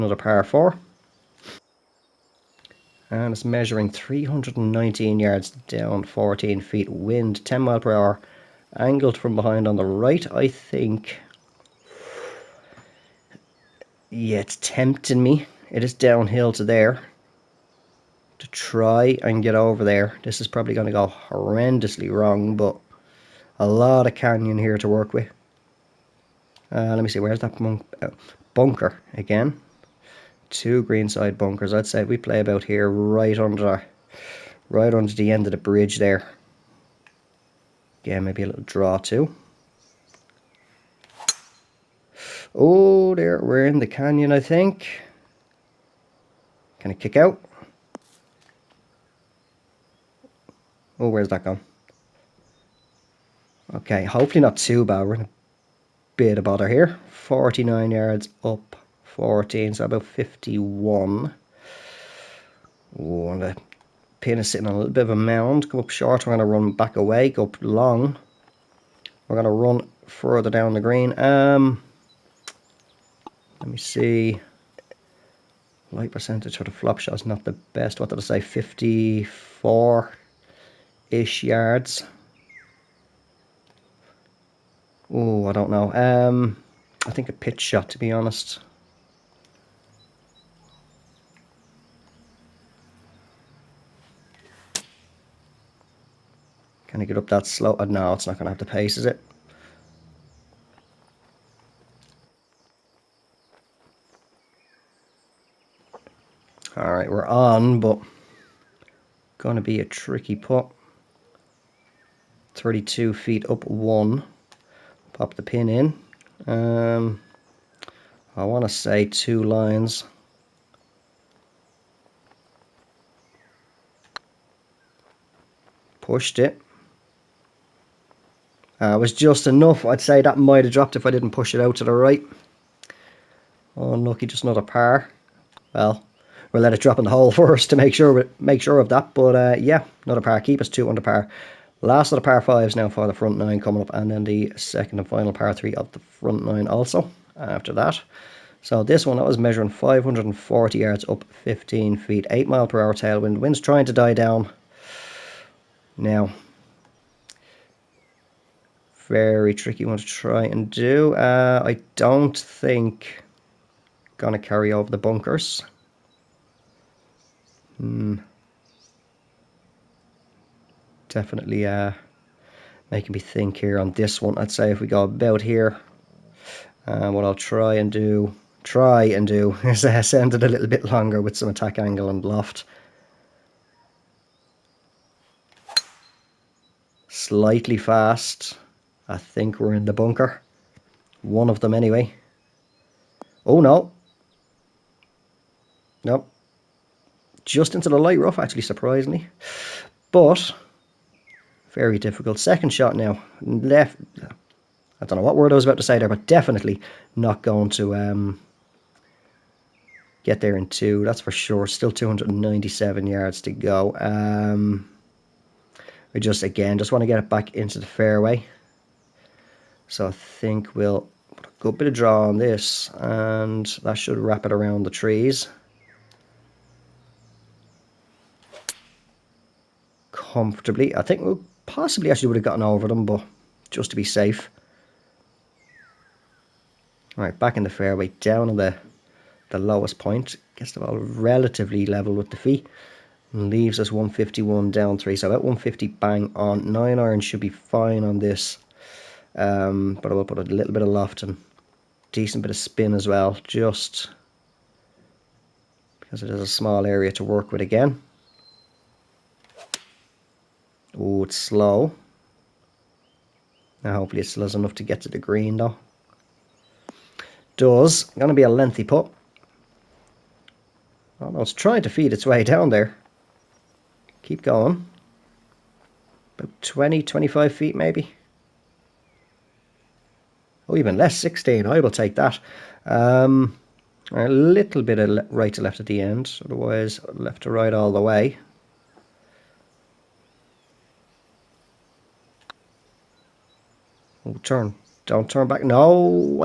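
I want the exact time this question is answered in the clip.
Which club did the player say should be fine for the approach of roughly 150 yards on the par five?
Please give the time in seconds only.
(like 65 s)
246 s.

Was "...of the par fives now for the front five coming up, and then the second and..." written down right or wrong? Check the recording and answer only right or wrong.
wrong.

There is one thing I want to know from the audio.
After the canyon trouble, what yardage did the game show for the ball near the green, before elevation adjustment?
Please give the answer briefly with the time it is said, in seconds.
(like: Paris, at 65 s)
49 yards, at 57 s.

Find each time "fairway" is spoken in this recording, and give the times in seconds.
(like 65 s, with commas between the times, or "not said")
217 s, 237 s.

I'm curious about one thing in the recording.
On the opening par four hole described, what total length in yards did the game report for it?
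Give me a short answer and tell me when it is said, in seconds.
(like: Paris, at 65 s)
319 yards, at 3 s.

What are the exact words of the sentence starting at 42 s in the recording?
Oh, there, we're in the canyon, I think.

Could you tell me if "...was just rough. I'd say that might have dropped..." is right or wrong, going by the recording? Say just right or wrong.
wrong.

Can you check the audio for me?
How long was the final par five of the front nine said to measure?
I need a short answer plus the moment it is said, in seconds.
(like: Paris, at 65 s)
540 yards, at 149 s.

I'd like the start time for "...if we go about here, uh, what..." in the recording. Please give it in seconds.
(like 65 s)
174 s.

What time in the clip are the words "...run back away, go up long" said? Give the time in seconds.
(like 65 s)
66 s.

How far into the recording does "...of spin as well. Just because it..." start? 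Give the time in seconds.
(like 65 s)
252 s.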